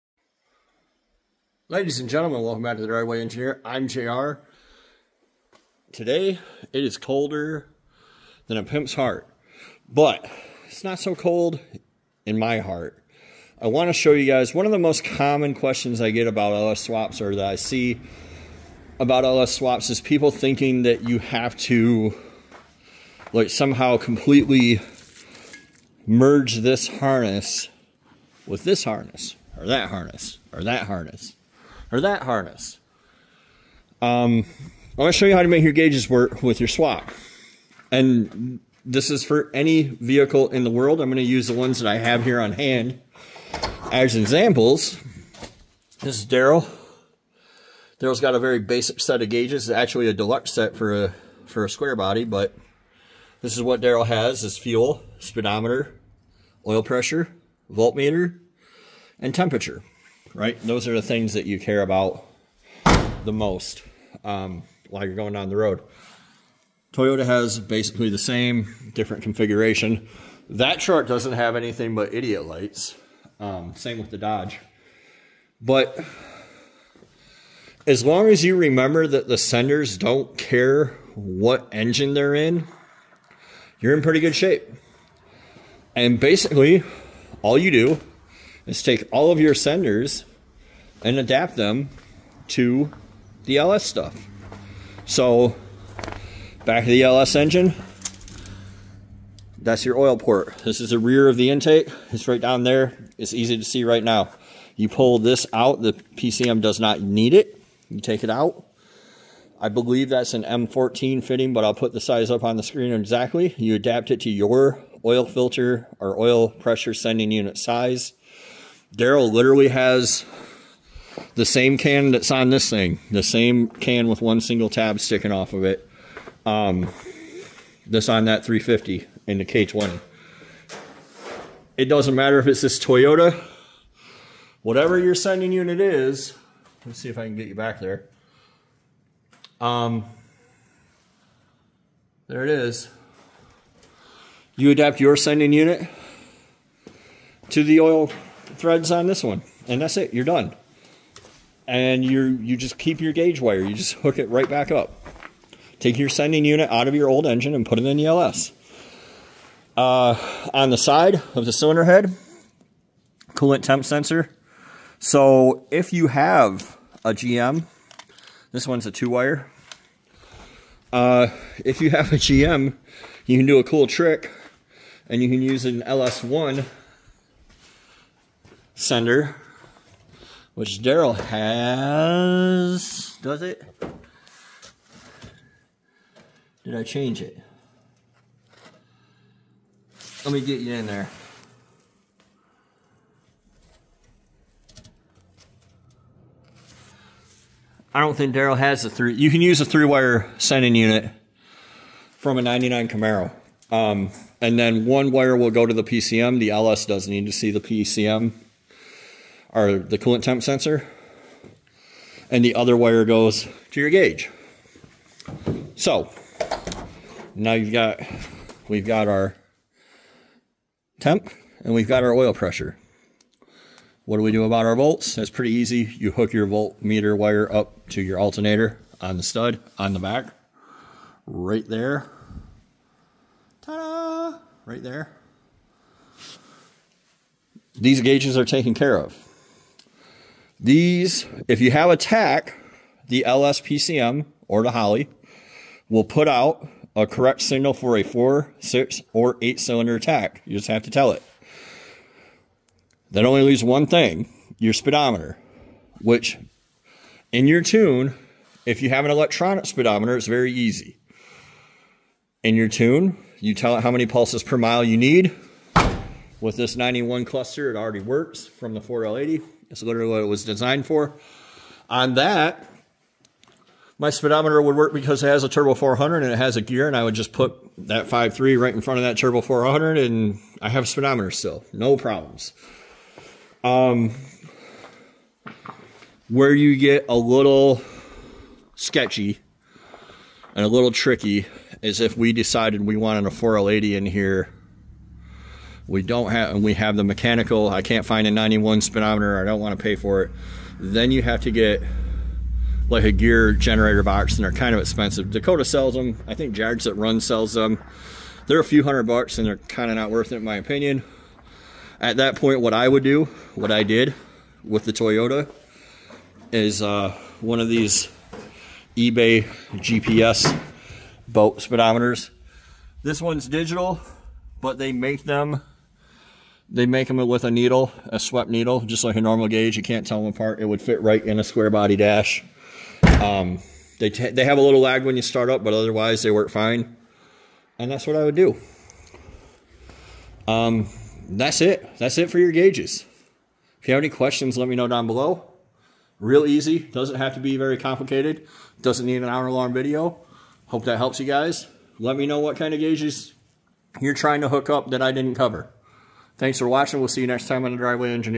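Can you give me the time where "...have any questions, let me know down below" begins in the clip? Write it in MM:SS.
05:43.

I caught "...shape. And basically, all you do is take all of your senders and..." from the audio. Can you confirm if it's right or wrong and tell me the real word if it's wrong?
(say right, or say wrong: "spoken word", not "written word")
right.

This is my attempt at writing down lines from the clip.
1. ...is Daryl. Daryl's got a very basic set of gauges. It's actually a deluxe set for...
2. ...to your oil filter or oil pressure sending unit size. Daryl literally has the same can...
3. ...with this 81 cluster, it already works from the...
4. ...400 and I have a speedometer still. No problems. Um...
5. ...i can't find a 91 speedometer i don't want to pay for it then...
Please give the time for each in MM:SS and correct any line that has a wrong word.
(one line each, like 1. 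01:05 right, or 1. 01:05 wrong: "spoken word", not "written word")
1. 00:46 right
2. 01:54 right
3. 04:26 wrong: "91", not "81"
4. 04:39 right
5. 04:57 right.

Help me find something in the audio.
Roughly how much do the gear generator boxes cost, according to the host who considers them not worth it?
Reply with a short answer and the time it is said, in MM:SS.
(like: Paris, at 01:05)
a few hundred bucks, at 05:08.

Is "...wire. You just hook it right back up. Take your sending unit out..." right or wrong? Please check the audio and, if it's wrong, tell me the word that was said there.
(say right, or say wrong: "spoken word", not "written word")
right.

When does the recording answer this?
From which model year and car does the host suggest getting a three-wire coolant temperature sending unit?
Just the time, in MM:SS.
03:22.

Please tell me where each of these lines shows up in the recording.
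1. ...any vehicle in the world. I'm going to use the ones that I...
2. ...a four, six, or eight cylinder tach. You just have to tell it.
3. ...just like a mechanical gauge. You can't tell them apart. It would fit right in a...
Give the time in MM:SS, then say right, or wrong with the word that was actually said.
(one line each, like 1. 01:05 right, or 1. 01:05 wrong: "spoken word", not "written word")
1. 00:39 right
2. 04:07 right
3. 05:28 wrong: "normal", not "mechanical".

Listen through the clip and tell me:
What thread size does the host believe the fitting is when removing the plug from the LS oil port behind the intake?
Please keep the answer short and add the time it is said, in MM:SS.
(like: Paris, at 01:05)
M14, at 01:50.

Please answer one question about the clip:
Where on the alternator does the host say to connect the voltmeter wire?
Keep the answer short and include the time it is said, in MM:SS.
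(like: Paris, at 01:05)
stud on the back, at 03:49.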